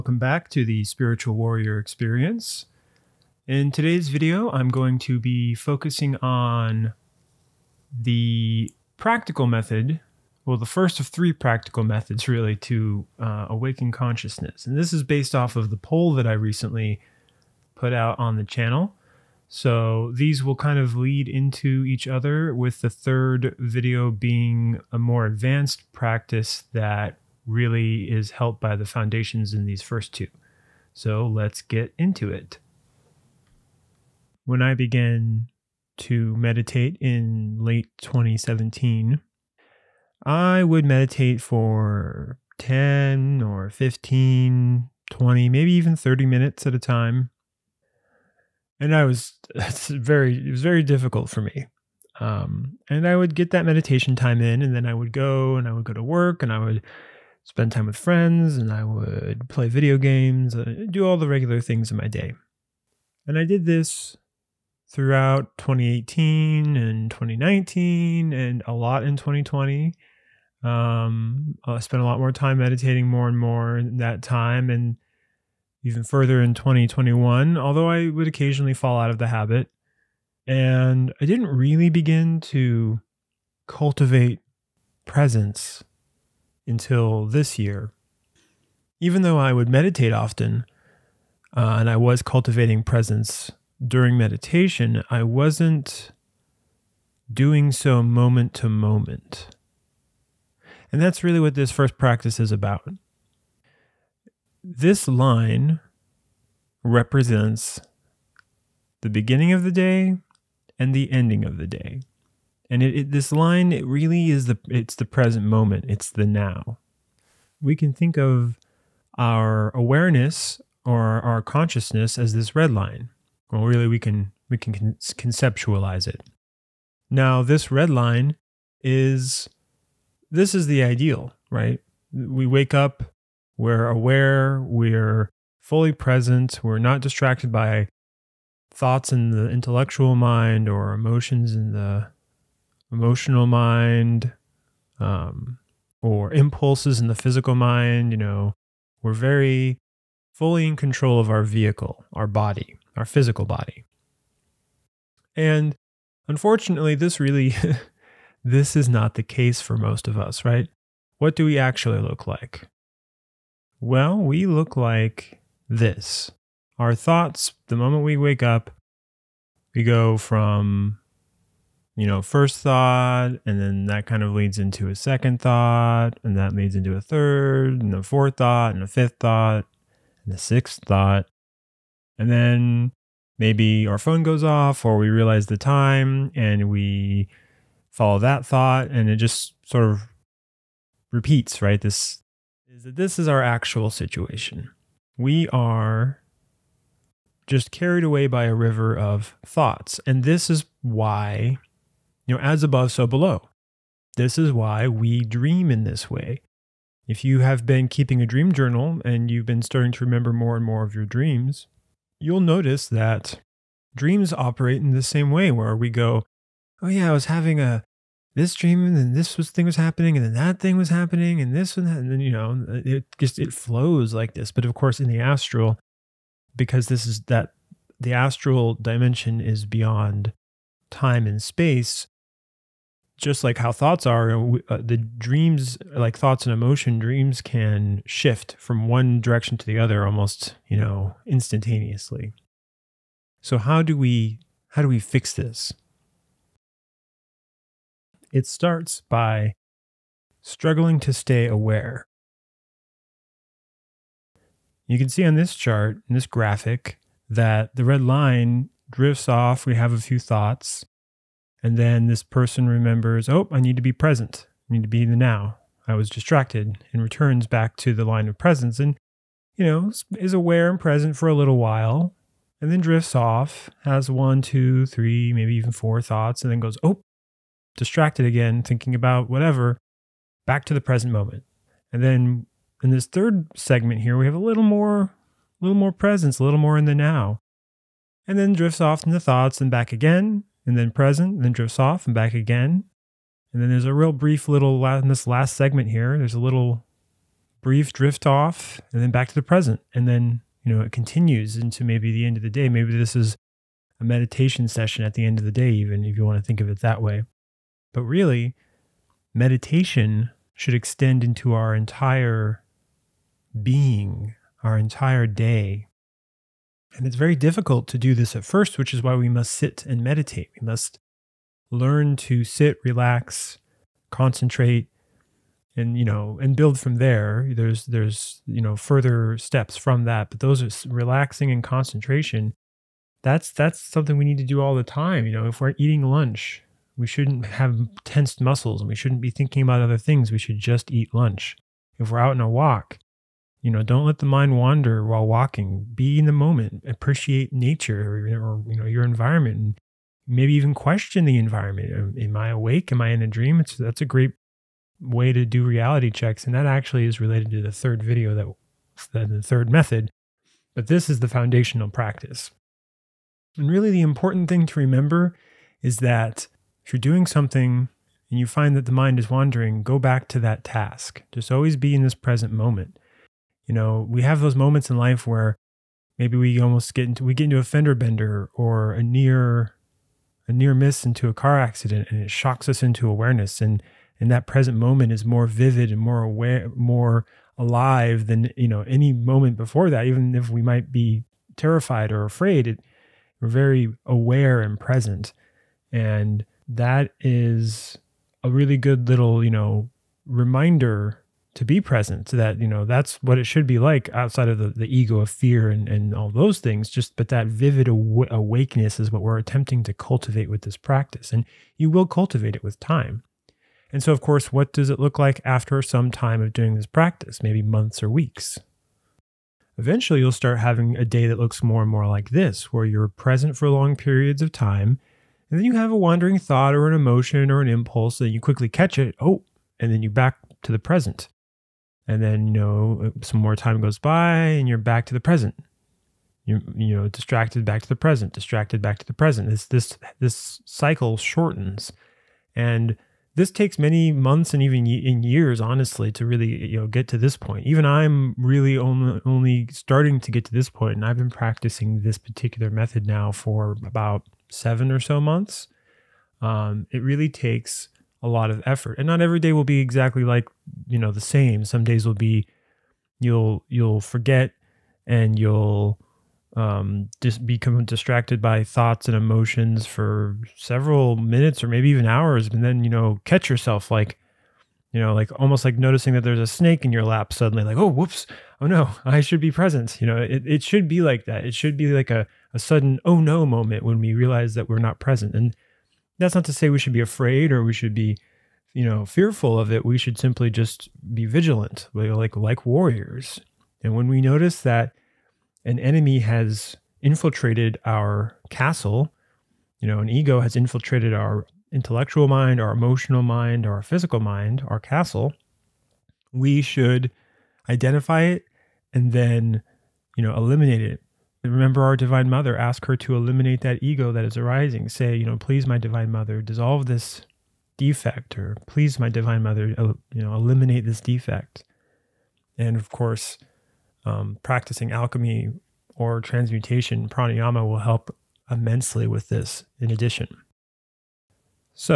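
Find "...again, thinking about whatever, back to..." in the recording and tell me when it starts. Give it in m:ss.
4:38.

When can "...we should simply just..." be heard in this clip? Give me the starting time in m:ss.
8:09.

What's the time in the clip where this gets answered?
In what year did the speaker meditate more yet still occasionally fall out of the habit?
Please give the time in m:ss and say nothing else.
1:16.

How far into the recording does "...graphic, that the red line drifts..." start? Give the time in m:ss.
4:16.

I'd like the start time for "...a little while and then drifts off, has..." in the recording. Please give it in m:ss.
4:31.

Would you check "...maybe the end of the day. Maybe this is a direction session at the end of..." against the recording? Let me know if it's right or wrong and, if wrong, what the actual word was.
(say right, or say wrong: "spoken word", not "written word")
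wrong: "meditation", not "direction".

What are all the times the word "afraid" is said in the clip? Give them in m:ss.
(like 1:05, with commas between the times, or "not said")
6:32, 8:06.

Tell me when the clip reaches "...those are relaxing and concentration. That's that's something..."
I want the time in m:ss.
5:30.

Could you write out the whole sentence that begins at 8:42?
And of course, um, practicing alchemy or transmutation, pranayama will help immensely with this in addition.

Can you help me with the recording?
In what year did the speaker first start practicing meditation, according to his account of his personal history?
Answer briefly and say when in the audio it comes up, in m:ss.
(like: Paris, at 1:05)
2017, at 0:37.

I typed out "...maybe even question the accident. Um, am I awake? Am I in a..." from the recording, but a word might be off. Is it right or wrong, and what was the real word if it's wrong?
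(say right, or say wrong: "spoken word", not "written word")
wrong: "environment", not "accident".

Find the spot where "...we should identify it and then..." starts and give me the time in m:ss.
8:26.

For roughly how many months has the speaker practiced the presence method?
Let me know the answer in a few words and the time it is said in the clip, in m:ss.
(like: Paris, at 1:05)
7, at 7:34.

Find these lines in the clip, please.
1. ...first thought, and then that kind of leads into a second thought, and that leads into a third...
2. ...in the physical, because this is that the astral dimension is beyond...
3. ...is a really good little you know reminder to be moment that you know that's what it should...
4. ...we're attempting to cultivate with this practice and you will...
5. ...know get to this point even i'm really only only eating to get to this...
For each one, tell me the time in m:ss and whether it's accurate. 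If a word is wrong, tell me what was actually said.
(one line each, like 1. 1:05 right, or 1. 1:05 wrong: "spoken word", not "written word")
1. 2:52 right
2. 3:44 wrong: "astral", not "physical"
3. 6:37 wrong: "present", not "moment"
4. 6:49 right
5. 7:26 wrong: "starting", not "eating".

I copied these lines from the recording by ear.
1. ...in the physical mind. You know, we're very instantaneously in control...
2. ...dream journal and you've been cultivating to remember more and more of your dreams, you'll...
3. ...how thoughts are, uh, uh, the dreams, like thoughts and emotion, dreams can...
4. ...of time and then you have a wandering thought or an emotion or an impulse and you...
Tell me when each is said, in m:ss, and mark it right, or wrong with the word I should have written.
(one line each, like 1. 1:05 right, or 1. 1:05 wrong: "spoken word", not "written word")
1. 2:26 wrong: "fully", not "instantaneously"
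2. 3:28 wrong: "starting", not "cultivating"
3. 3:53 right
4. 7:04 right.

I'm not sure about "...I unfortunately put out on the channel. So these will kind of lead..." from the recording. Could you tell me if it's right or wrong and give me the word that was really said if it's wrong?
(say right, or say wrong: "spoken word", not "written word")
wrong: "recently", not "unfortunately".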